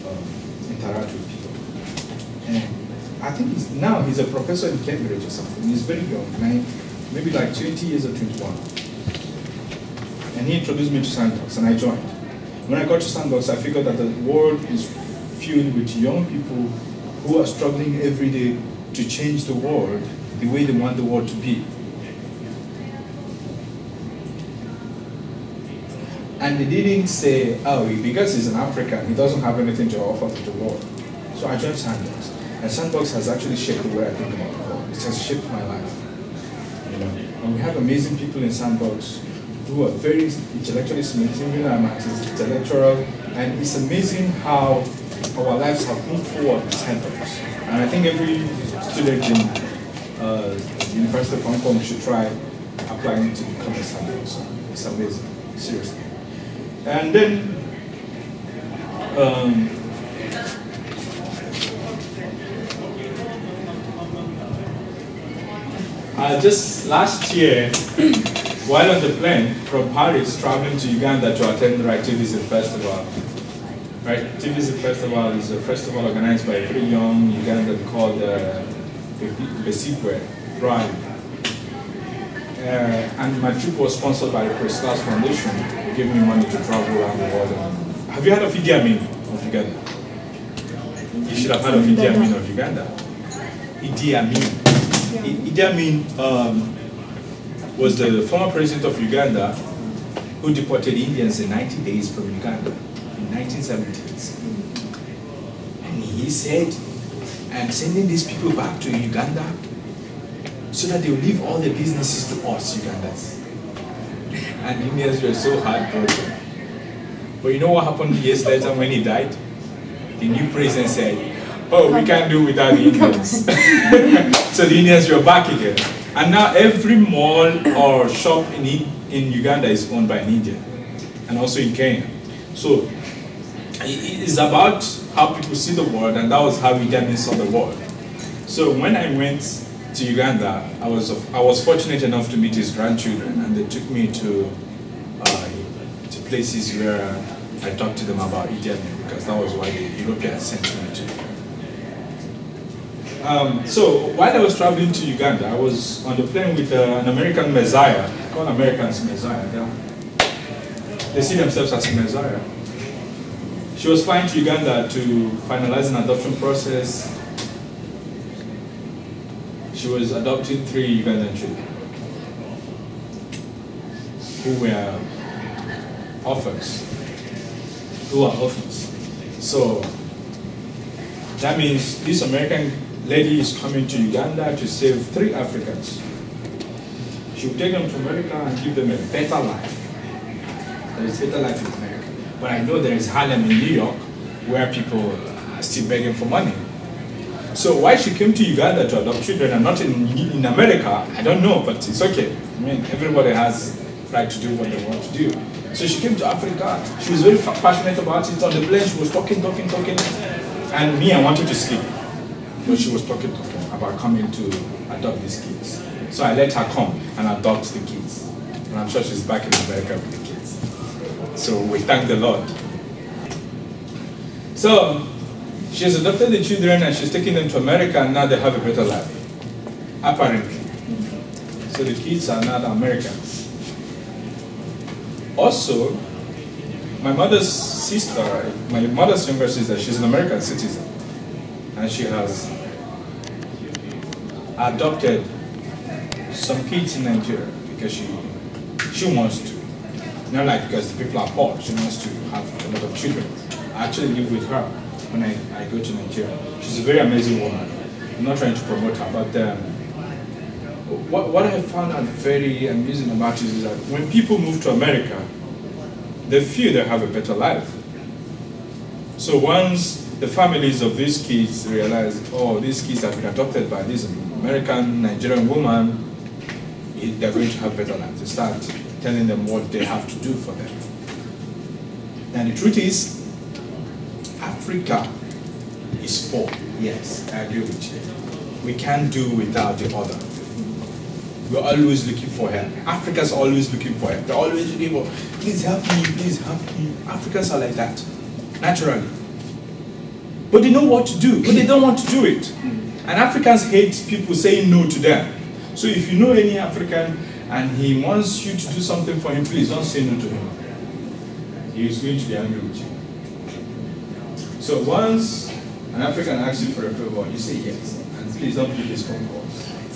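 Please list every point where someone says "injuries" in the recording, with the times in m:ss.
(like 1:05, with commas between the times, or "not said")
not said.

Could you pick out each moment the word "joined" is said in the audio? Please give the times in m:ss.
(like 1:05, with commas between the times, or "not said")
0:11, 0:31.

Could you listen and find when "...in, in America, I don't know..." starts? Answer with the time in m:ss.
3:19.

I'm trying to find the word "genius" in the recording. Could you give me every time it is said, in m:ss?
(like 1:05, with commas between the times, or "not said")
not said.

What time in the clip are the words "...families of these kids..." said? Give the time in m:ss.
4:30.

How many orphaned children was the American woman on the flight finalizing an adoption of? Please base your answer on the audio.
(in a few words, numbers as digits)
3.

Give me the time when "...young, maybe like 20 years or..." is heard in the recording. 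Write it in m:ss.
0:06.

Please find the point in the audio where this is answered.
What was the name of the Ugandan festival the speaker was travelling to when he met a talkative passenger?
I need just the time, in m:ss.
1:11.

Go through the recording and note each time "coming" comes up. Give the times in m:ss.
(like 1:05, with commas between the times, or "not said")
3:03, 3:33.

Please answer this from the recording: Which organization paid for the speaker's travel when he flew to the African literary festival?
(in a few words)
Prince Claus Foundation.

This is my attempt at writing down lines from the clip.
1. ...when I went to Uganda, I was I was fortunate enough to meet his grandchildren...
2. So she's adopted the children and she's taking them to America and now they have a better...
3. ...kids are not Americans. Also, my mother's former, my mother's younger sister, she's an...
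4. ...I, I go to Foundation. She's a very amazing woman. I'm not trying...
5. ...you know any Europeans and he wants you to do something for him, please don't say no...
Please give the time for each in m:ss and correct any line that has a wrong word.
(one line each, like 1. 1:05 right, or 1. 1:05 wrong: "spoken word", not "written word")
1. 2:18 right
2. 3:44 right
3. 3:51 wrong: "sister", not "former"
4. 4:15 wrong: "Nigeria", not "Foundation"
5. 5:06 wrong: "African", not "Europeans".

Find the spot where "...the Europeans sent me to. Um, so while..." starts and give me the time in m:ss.
2:29.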